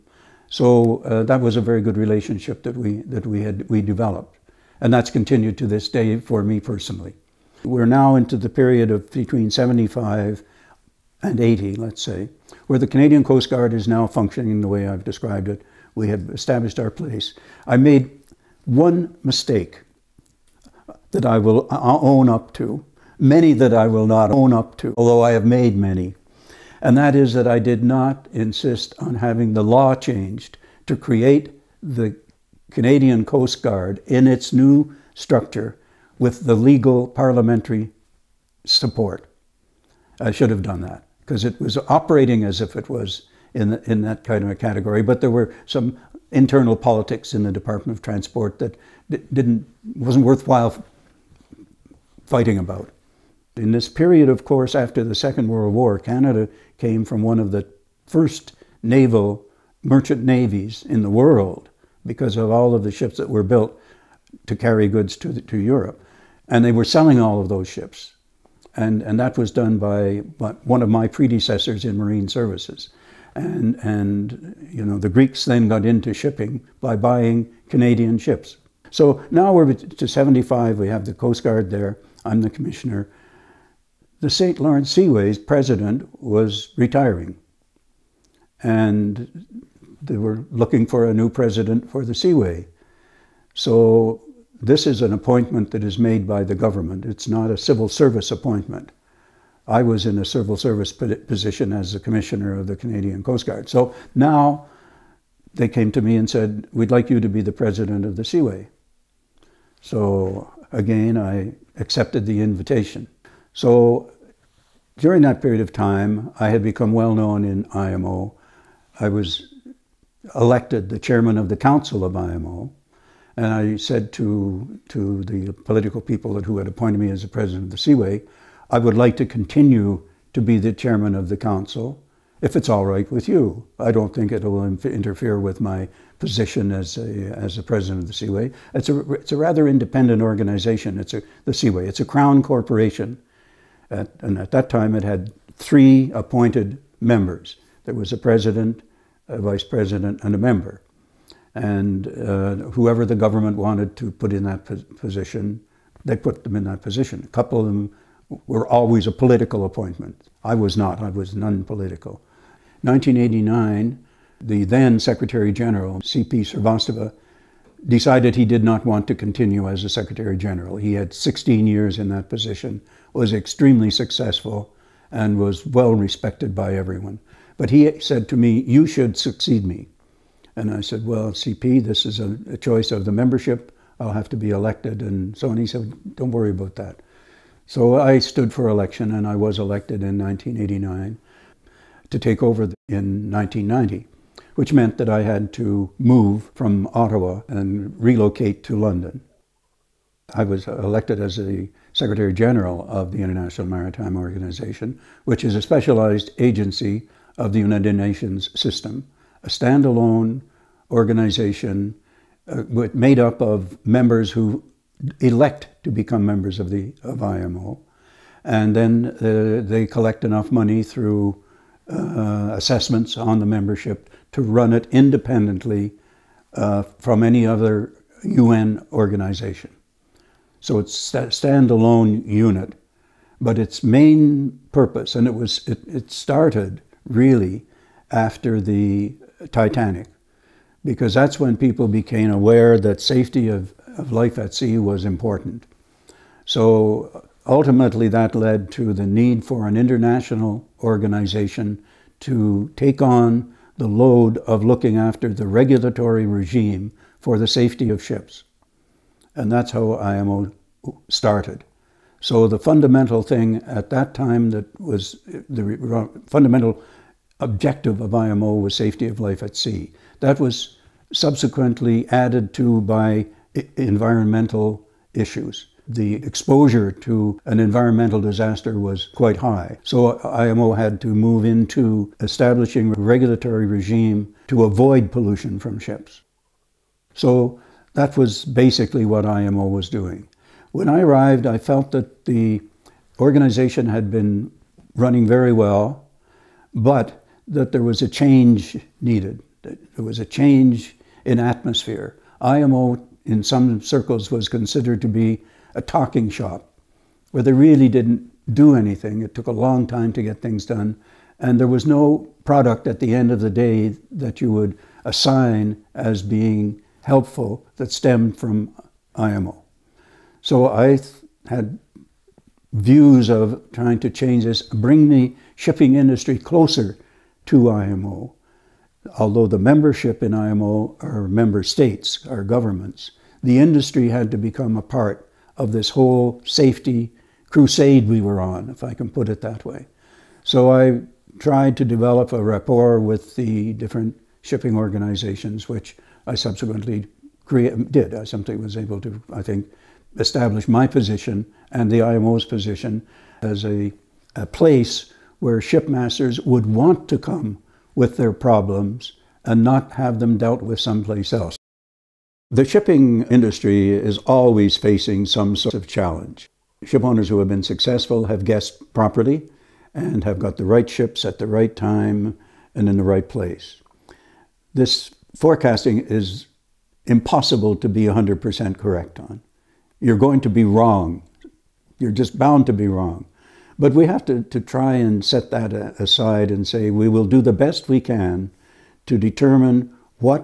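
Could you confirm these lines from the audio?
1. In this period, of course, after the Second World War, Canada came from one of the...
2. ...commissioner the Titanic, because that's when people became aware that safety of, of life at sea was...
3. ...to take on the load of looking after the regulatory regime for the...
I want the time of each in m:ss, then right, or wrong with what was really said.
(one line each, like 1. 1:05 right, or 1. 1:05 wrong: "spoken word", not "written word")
1. 0:53 right
2. 3:58 wrong: "after", not "commissioner"
3. 4:12 right.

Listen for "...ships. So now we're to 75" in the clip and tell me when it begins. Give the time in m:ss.
1:18.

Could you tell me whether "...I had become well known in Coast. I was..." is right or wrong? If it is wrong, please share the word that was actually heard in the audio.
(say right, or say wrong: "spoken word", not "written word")
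wrong: "IMO", not "Coast".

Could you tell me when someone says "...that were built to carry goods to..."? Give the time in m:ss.
1:03.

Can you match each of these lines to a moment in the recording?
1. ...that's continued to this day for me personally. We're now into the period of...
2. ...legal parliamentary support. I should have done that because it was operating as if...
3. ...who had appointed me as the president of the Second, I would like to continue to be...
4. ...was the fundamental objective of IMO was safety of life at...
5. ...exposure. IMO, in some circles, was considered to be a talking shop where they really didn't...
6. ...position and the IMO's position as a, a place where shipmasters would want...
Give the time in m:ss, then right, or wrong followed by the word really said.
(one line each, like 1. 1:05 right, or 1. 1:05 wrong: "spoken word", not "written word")
1. 0:04 right
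2. 0:36 right
3. 2:06 wrong: "Seaway", not "Second"
4. 4:24 right
5. 5:01 wrong: "atmosphere", not "exposure"
6. 5:50 right.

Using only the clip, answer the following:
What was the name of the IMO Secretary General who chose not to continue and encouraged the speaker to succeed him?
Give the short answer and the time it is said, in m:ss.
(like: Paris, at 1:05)
C.P. Srivastava, at 2:46.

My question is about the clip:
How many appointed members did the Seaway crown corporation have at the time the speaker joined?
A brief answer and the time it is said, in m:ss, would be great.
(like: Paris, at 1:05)
3, at 2:25.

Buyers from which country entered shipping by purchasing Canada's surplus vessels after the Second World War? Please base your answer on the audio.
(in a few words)
Greeks.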